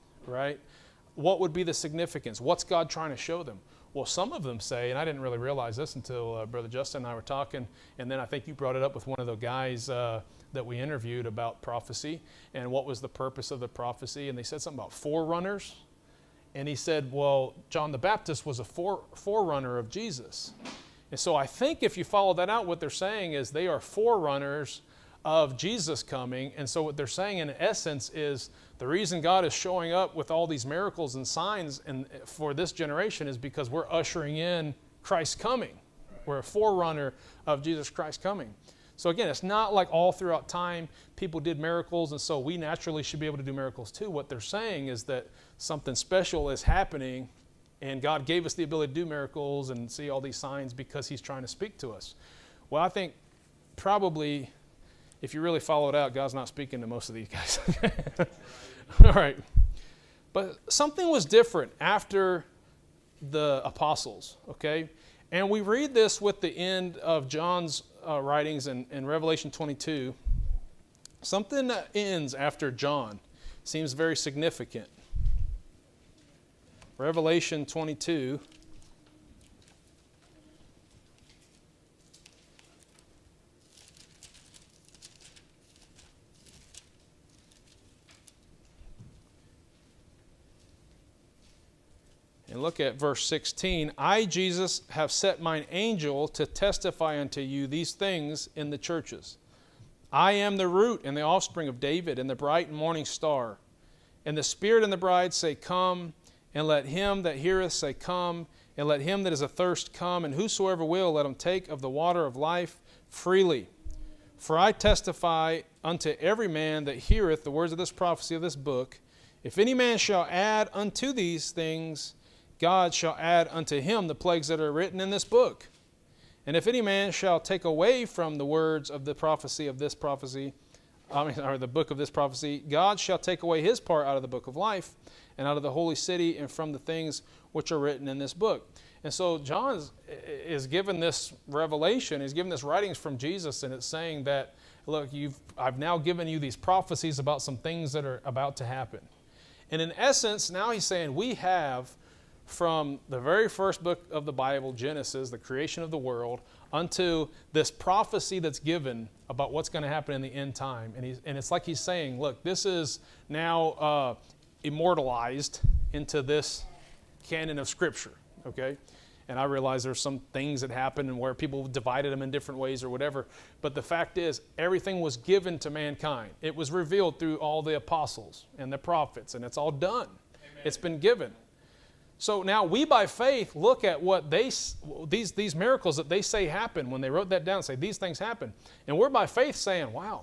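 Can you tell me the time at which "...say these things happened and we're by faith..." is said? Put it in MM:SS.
03:07.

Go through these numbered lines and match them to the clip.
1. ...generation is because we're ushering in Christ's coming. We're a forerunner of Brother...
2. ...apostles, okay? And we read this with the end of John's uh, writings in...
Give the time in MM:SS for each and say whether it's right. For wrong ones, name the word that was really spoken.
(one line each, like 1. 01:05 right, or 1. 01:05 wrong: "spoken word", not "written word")
1. 00:32 wrong: "Jesus", not "Brother"
2. 01:03 right.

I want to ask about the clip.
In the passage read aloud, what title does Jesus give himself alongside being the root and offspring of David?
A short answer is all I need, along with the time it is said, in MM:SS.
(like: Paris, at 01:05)
bright morning star, at 01:42.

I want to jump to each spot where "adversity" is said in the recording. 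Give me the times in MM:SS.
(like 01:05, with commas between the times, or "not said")
not said.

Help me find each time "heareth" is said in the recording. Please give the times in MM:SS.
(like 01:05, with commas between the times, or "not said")
01:47, 01:56.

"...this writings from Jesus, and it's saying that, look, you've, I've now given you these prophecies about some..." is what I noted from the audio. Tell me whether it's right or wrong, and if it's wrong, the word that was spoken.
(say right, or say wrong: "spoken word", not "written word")
right.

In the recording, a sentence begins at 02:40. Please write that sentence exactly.
And, he's, and it's like he's saying, look, this is now uh, immortalized into this canon of Scripture, okay?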